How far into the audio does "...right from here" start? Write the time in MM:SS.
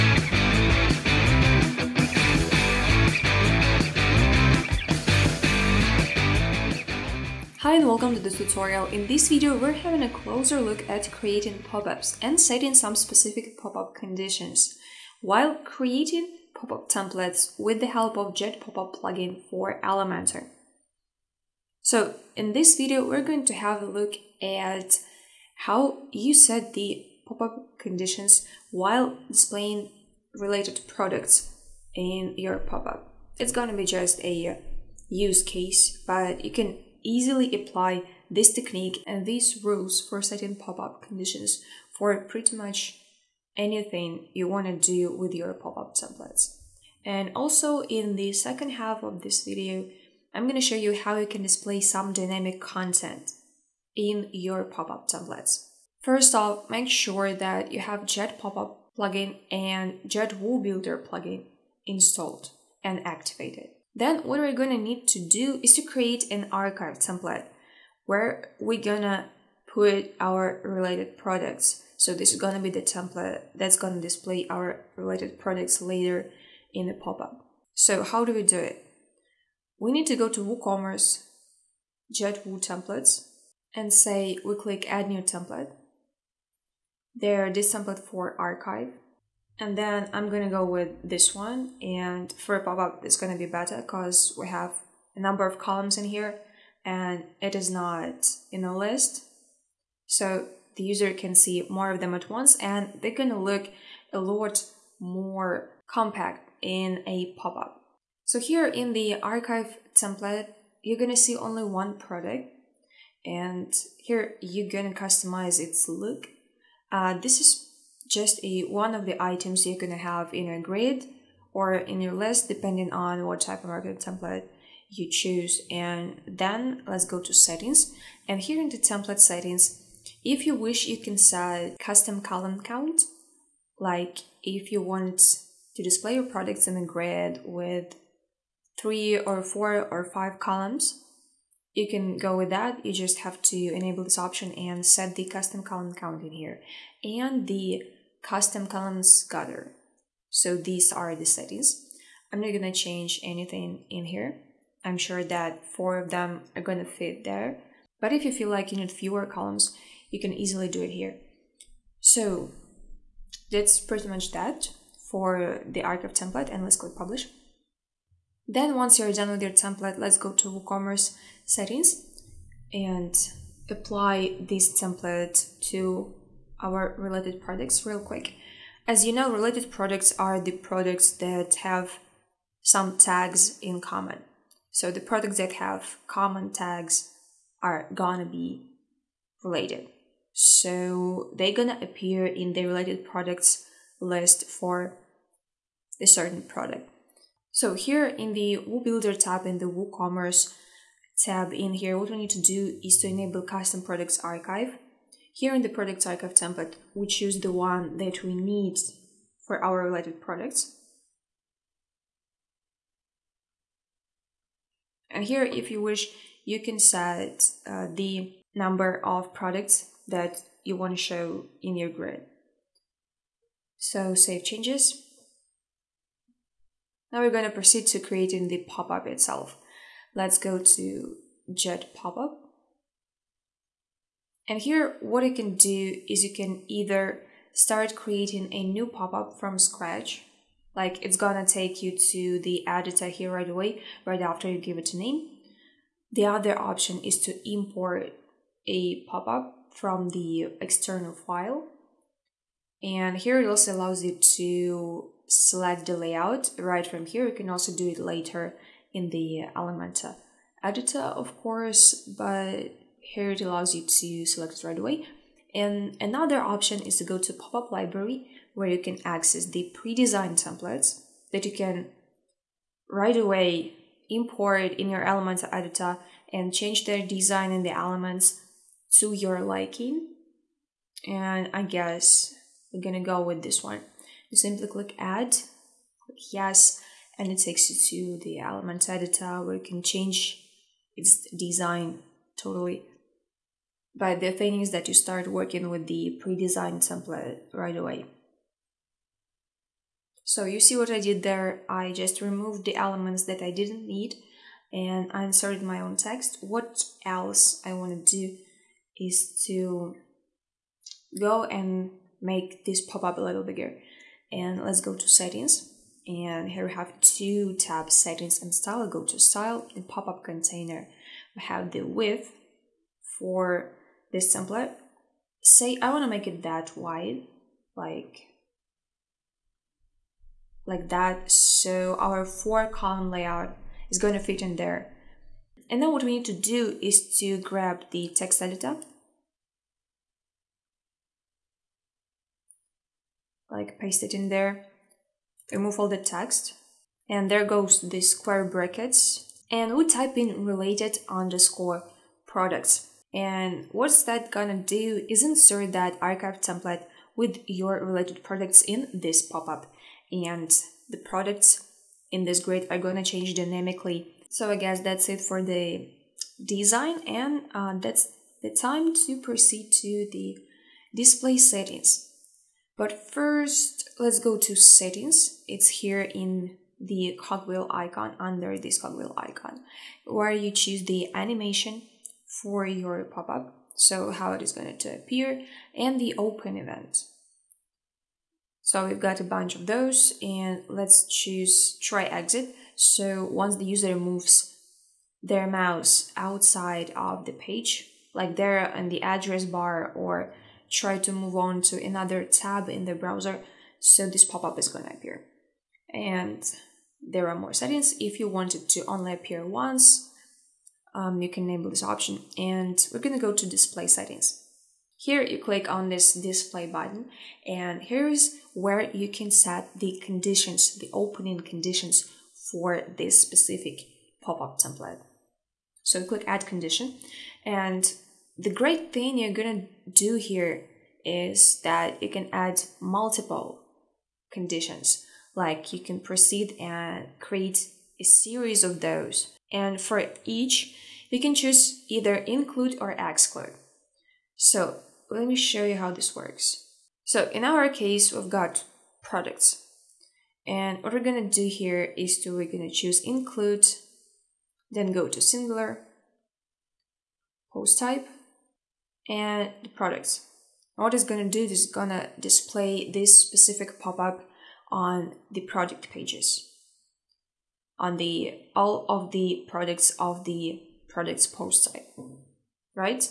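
04:16.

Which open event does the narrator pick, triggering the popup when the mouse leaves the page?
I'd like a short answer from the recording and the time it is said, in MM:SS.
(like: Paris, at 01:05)
try exit, at 06:31.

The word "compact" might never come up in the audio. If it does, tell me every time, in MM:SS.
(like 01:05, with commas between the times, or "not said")
01:45.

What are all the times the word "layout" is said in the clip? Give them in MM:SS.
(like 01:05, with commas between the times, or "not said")
04:15, 05:33.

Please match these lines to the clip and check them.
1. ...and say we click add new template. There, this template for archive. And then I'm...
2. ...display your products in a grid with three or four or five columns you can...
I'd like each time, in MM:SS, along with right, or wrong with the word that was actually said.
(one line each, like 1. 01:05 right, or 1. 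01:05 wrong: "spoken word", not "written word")
1. 01:23 right
2. 02:15 right.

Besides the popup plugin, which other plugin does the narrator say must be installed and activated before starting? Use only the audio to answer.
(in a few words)
JetWooBuilder.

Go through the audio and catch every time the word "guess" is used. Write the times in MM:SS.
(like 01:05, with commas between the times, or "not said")
04:41, 06:04.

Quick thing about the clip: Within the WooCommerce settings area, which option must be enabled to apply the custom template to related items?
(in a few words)
custom products archive.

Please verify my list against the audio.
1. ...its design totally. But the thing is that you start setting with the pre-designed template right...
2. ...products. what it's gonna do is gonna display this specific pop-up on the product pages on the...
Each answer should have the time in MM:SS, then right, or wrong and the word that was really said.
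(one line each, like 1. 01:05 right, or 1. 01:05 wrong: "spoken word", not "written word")
1. 04:50 wrong: "working", not "setting"
2. 07:39 right.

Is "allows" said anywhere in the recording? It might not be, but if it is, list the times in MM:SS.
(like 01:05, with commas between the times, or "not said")
04:13, 04:23.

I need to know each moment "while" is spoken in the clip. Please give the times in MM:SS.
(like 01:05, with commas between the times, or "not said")
00:15, 00:28.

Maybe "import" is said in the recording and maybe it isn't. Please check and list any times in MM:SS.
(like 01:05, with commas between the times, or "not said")
04:07, 04:34.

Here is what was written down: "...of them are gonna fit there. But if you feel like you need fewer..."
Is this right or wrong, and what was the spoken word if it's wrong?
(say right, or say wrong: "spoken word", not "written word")
right.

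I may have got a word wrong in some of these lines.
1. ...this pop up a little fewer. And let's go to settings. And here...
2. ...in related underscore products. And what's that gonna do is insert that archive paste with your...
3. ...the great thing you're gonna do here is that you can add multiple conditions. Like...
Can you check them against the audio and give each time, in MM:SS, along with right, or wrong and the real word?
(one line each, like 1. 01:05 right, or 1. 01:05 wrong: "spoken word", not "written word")
1. 05:12 wrong: "bigger", not "fewer"
2. 05:50 wrong: "template", not "paste"
3. 07:08 right.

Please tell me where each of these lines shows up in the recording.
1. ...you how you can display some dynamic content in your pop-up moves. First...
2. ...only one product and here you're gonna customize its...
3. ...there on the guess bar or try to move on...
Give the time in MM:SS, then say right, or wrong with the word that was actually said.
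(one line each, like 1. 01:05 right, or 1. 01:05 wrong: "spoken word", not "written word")
1. 00:50 wrong: "templates", not "moves"
2. 01:51 right
3. 06:38 wrong: "address", not "guess".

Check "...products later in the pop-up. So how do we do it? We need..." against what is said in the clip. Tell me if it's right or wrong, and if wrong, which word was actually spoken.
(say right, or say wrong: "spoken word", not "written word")
right.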